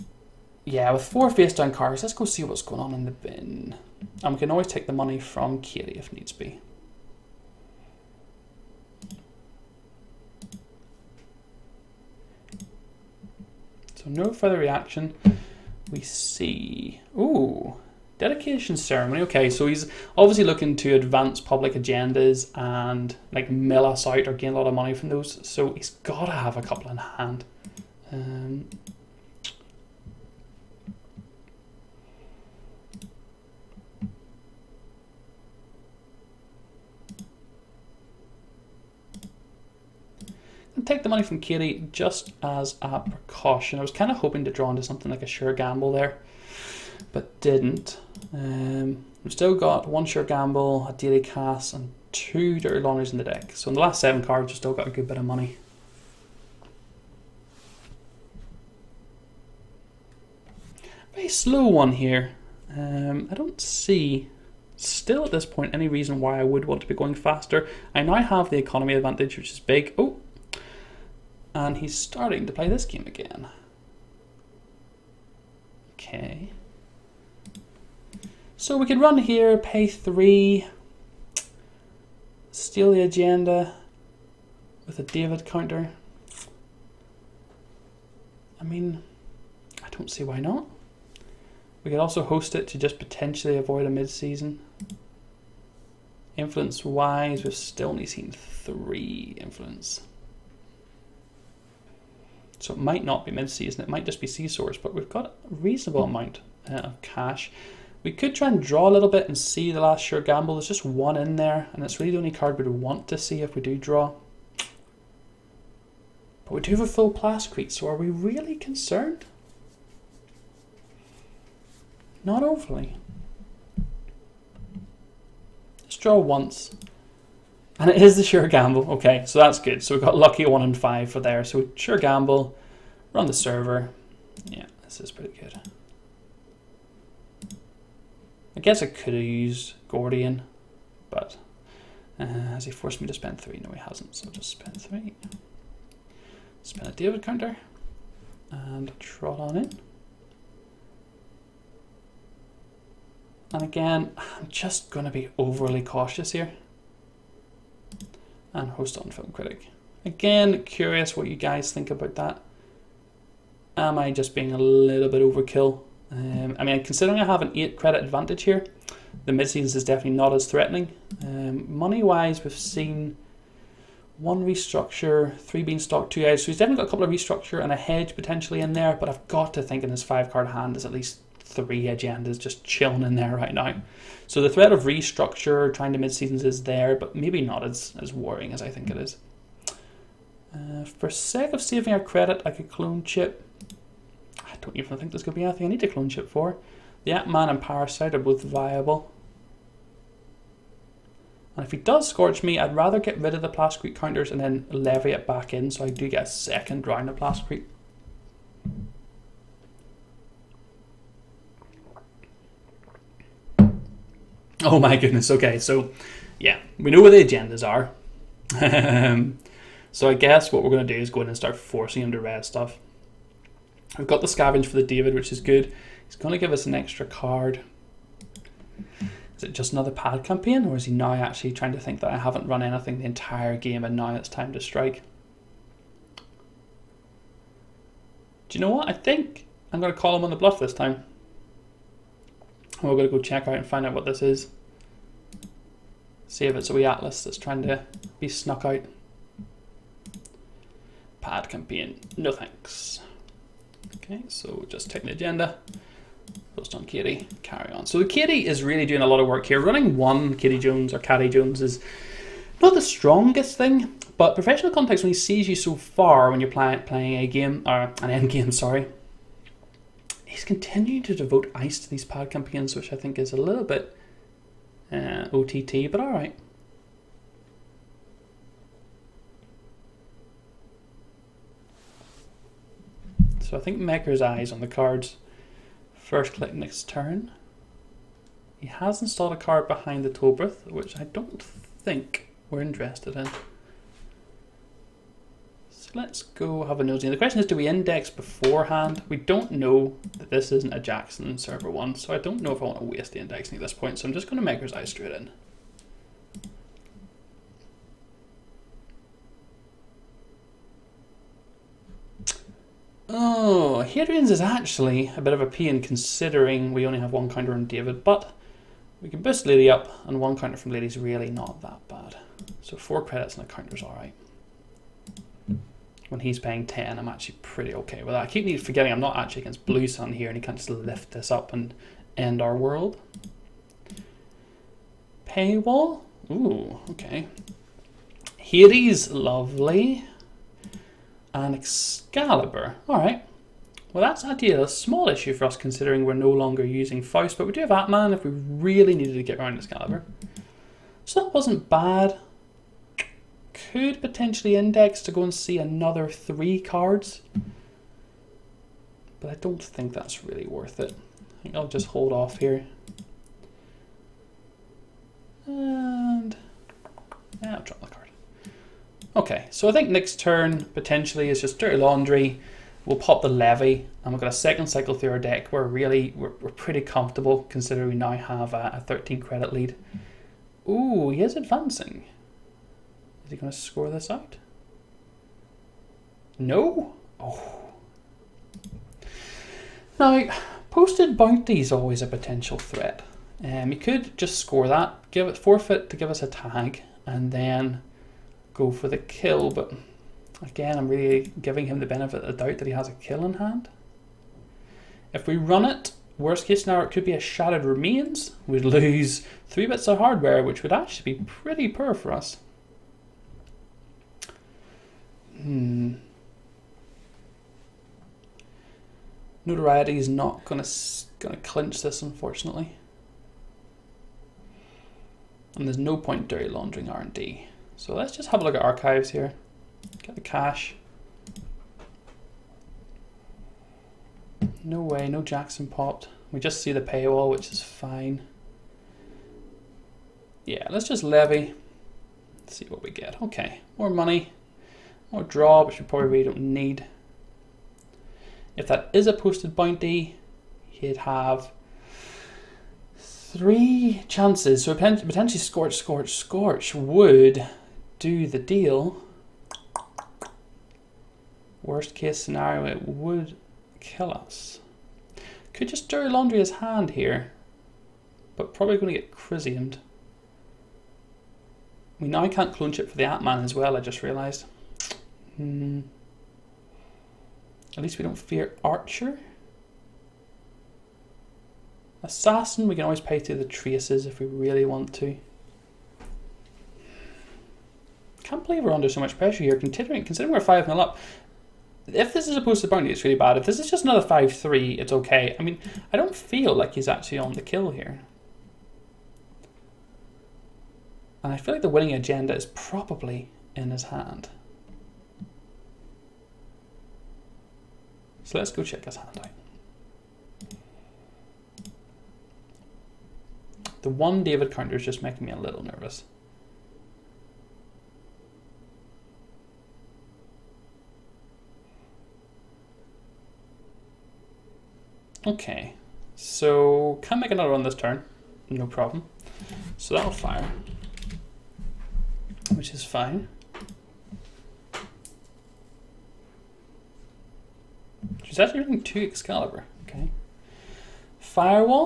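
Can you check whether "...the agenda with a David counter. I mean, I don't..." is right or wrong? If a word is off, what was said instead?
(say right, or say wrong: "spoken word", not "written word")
right.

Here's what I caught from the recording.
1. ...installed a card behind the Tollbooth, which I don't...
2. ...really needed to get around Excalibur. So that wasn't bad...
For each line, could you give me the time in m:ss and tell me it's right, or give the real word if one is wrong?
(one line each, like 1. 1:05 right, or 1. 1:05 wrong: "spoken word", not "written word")
1. 4:49 right
2. 5:48 right.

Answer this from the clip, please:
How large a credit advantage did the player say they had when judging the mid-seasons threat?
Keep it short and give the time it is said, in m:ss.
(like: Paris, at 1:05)
8 credits, at 2:47.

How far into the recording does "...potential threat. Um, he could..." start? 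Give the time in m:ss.
6:32.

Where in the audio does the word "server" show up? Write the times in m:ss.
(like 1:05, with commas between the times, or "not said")
2:13, 5:01.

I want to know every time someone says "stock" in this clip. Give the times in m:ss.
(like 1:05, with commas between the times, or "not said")
2:56.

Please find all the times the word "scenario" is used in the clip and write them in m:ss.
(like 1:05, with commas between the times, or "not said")
6:46, 7:42.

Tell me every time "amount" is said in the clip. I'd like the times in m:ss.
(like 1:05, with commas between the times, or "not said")
1:46.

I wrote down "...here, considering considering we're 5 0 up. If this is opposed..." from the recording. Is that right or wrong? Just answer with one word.
right.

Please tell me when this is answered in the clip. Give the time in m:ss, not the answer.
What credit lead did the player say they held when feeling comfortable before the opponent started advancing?
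6:18.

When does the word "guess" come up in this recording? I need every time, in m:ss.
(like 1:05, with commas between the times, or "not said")
2:18, 3:40.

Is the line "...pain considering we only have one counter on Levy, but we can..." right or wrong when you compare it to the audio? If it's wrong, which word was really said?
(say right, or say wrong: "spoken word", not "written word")
wrong: "David", not "Levy".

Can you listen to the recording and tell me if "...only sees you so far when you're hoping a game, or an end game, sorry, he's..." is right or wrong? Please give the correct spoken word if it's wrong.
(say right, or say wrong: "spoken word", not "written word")
wrong: "playing", not "hoping".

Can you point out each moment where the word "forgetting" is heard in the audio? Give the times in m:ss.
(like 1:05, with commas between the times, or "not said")
5:28.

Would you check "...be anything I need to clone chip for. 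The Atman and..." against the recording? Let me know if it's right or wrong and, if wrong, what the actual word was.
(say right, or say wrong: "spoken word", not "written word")
right.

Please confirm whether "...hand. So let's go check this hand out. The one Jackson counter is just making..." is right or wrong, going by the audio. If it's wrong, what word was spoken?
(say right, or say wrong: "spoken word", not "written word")
wrong: "David", not "Jackson".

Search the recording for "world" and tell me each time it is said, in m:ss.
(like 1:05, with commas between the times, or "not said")
5:32.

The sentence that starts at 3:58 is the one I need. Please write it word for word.
I think I'm going to call him on the bluff this time.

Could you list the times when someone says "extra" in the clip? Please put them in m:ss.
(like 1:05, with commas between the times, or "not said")
3:46.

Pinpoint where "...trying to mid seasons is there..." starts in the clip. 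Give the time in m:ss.
3:05.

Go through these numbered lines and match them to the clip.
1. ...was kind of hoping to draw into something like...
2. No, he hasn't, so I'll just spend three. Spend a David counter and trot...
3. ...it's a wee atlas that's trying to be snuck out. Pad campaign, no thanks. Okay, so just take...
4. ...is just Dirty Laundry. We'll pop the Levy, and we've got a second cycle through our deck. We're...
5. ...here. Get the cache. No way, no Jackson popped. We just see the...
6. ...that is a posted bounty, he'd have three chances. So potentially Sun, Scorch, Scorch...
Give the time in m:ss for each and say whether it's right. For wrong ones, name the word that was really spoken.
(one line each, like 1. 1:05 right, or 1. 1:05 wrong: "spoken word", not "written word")
1. 0:43 right
2. 2:23 right
3. 4:06 right
4. 6:11 right
5. 7:09 right
6. 7:28 wrong: "Scorch", not "Sun".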